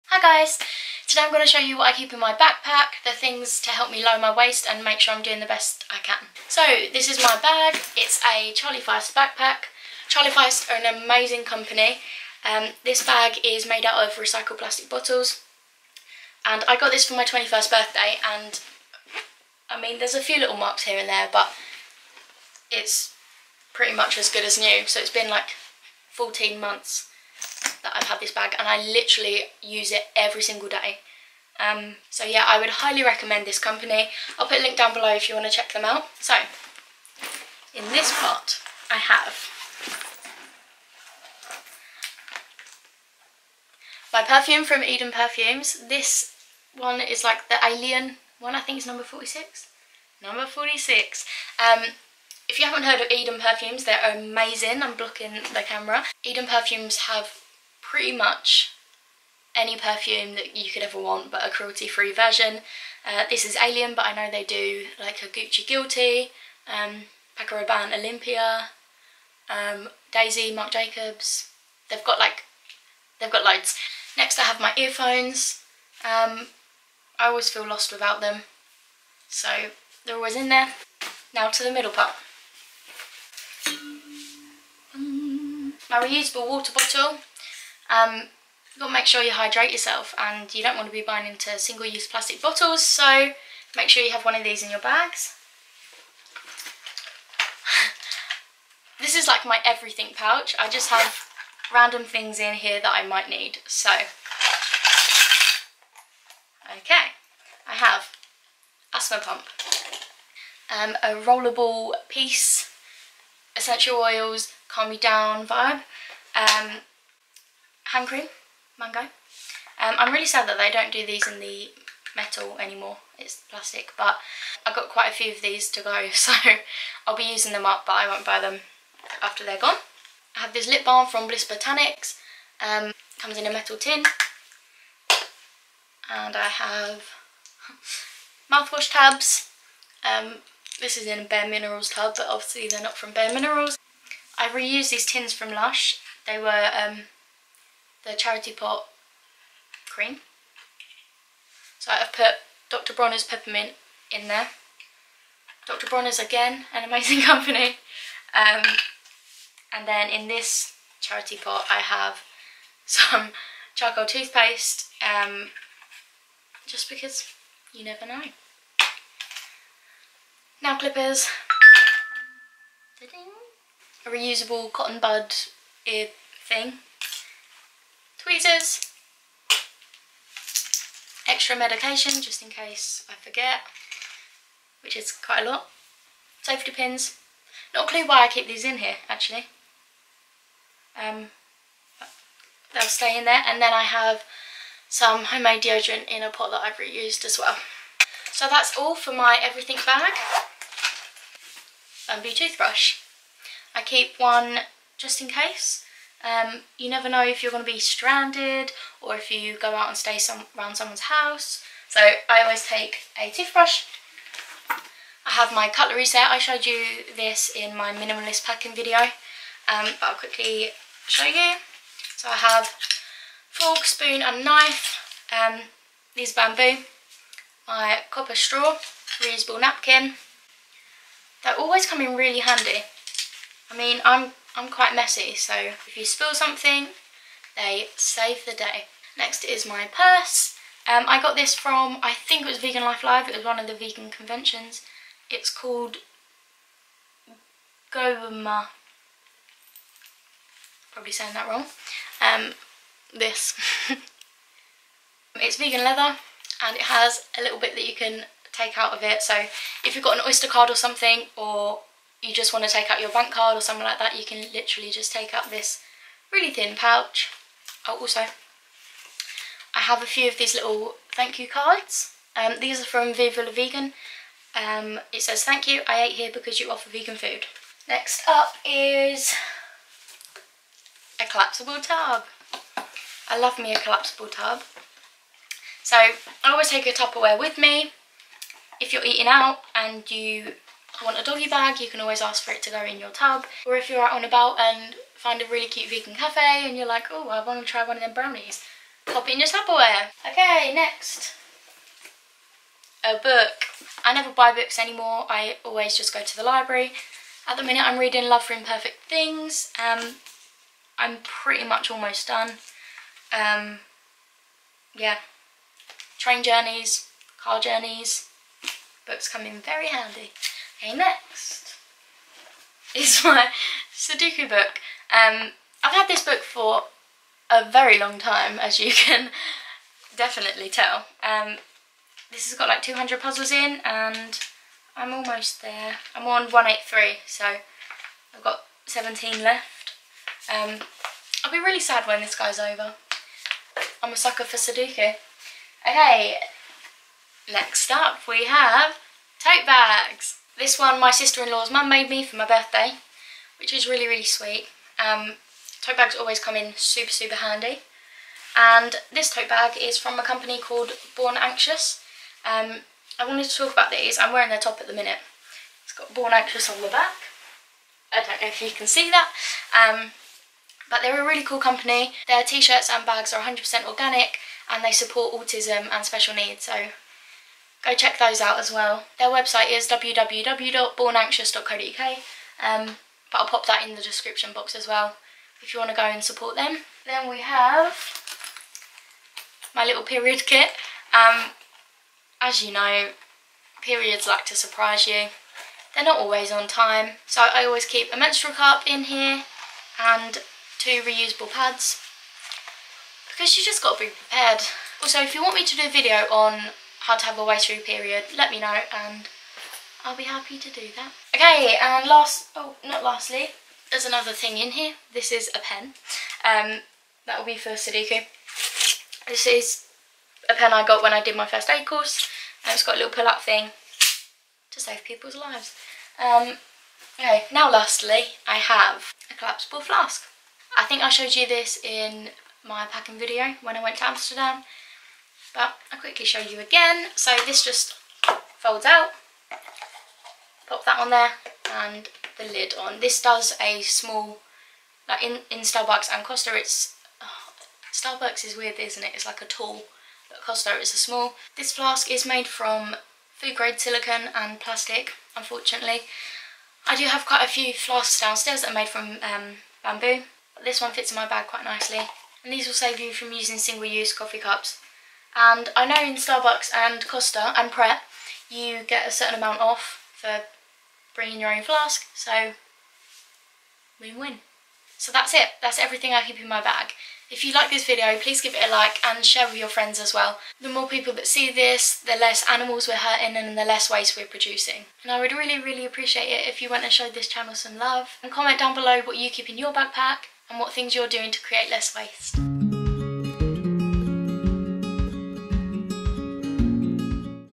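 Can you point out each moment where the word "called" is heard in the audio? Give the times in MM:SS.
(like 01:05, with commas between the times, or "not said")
04:05, 06:00.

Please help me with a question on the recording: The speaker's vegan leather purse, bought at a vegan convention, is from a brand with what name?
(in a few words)
Goma.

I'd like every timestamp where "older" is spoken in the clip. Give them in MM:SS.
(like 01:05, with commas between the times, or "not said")
not said.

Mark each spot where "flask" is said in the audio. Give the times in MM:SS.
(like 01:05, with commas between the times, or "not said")
07:09, 07:31, 07:37, 07:51.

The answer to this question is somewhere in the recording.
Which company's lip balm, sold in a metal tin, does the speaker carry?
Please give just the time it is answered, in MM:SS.
02:11.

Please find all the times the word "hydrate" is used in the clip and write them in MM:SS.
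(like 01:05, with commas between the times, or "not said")
01:29.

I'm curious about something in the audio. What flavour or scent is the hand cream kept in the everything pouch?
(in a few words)
mango.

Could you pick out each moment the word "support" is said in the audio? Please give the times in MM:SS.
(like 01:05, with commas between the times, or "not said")
06:14, 06:26.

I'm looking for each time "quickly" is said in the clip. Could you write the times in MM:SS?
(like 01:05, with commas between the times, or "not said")
03:40, 07:16.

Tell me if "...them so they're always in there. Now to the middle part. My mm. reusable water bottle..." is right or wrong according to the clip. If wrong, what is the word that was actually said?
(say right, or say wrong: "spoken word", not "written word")
right.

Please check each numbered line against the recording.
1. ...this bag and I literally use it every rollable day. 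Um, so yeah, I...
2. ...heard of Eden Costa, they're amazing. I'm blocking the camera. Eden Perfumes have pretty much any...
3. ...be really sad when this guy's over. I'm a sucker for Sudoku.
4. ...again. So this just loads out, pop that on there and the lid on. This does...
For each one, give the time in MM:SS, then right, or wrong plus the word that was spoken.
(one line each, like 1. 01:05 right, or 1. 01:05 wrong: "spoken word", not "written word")
1. 00:28 wrong: "single", not "rollable"
2. 00:52 wrong: "Perfumes", not "Costa"
3. 05:41 right
4. 07:16 wrong: "folds", not "loads".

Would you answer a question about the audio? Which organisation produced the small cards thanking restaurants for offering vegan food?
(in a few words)
Viva La Vegan.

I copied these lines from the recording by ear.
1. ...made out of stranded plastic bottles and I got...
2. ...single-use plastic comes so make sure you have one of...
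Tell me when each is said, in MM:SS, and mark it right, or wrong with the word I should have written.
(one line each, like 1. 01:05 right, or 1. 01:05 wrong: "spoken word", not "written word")
1. 00:13 wrong: "recycled", not "stranded"
2. 01:31 wrong: "bottles", not "comes".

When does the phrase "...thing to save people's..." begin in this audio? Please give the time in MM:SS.
07:03.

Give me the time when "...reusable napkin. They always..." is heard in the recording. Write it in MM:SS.
03:49.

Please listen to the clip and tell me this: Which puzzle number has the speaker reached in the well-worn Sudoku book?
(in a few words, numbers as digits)
183.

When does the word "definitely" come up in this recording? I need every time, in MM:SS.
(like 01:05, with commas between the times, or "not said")
05:30.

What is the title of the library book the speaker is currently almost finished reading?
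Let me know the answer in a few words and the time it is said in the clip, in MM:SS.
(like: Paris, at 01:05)
Love for Imperfect Things, at 05:08.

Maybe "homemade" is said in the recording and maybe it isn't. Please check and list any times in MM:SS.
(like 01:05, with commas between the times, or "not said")
03:15.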